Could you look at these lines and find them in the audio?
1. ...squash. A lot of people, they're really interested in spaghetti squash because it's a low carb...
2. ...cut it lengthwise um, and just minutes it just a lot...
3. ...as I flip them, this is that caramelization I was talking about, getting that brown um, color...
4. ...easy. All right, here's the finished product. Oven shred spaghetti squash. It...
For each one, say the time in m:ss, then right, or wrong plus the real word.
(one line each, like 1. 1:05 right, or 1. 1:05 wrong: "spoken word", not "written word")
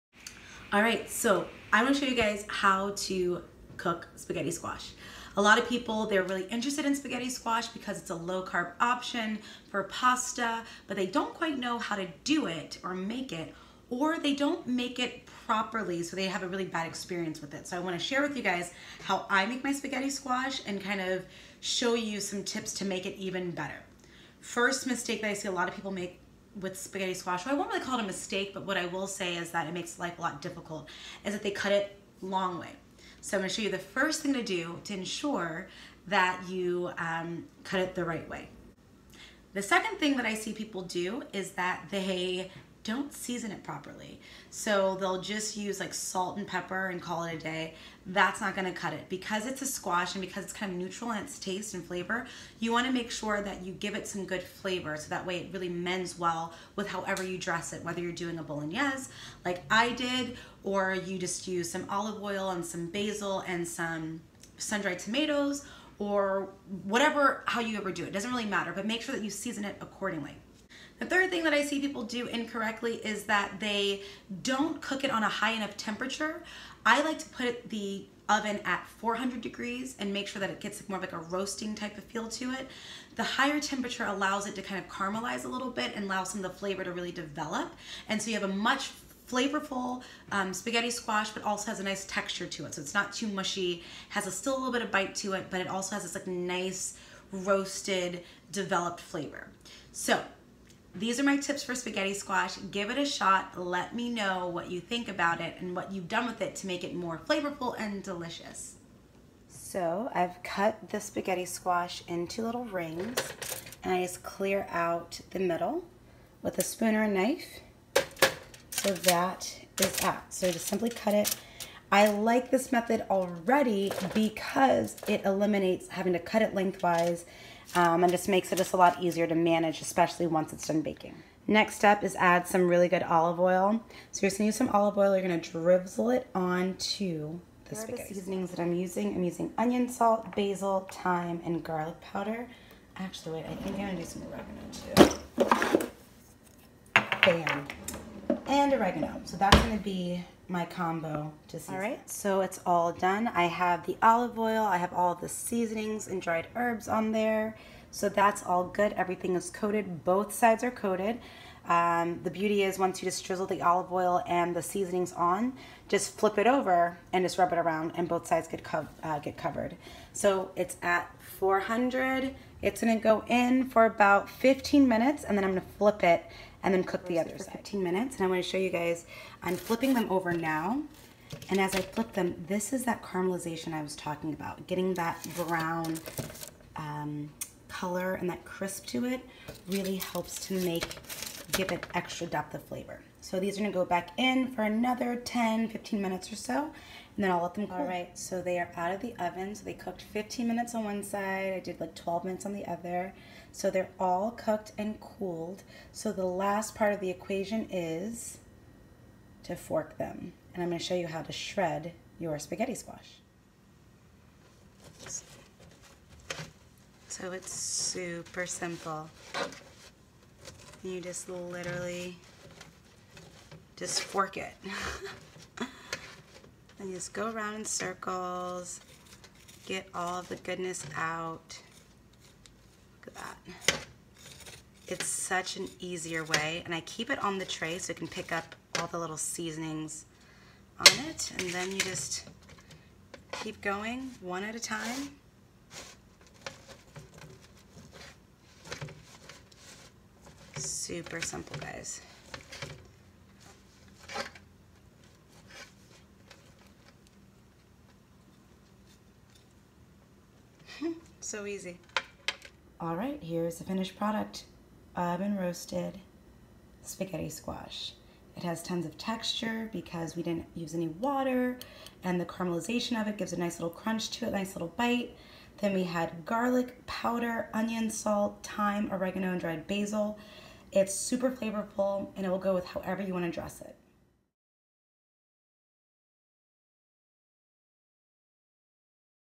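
1. 0:04 right
2. 2:06 wrong: "makes", not "minutes"
3. 3:01 right
4. 4:21 wrong: "roasted", not "shred".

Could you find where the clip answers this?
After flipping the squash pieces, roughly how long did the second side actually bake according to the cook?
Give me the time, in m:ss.
3:21.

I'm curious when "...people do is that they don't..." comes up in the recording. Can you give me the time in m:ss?
0:40.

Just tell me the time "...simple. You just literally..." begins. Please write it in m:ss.
3:38.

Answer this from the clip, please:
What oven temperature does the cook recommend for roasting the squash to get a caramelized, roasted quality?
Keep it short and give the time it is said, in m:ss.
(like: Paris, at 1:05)
400 degrees, at 1:18.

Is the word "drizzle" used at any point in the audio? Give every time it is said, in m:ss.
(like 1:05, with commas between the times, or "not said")
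2:15, 2:43.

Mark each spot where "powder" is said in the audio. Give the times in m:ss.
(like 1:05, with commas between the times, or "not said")
2:21, 4:36.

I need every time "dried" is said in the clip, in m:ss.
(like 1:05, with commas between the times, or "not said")
1:04, 2:36, 4:39.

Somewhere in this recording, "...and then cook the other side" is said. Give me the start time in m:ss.
2:56.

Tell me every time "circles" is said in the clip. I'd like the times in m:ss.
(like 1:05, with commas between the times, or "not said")
3:47.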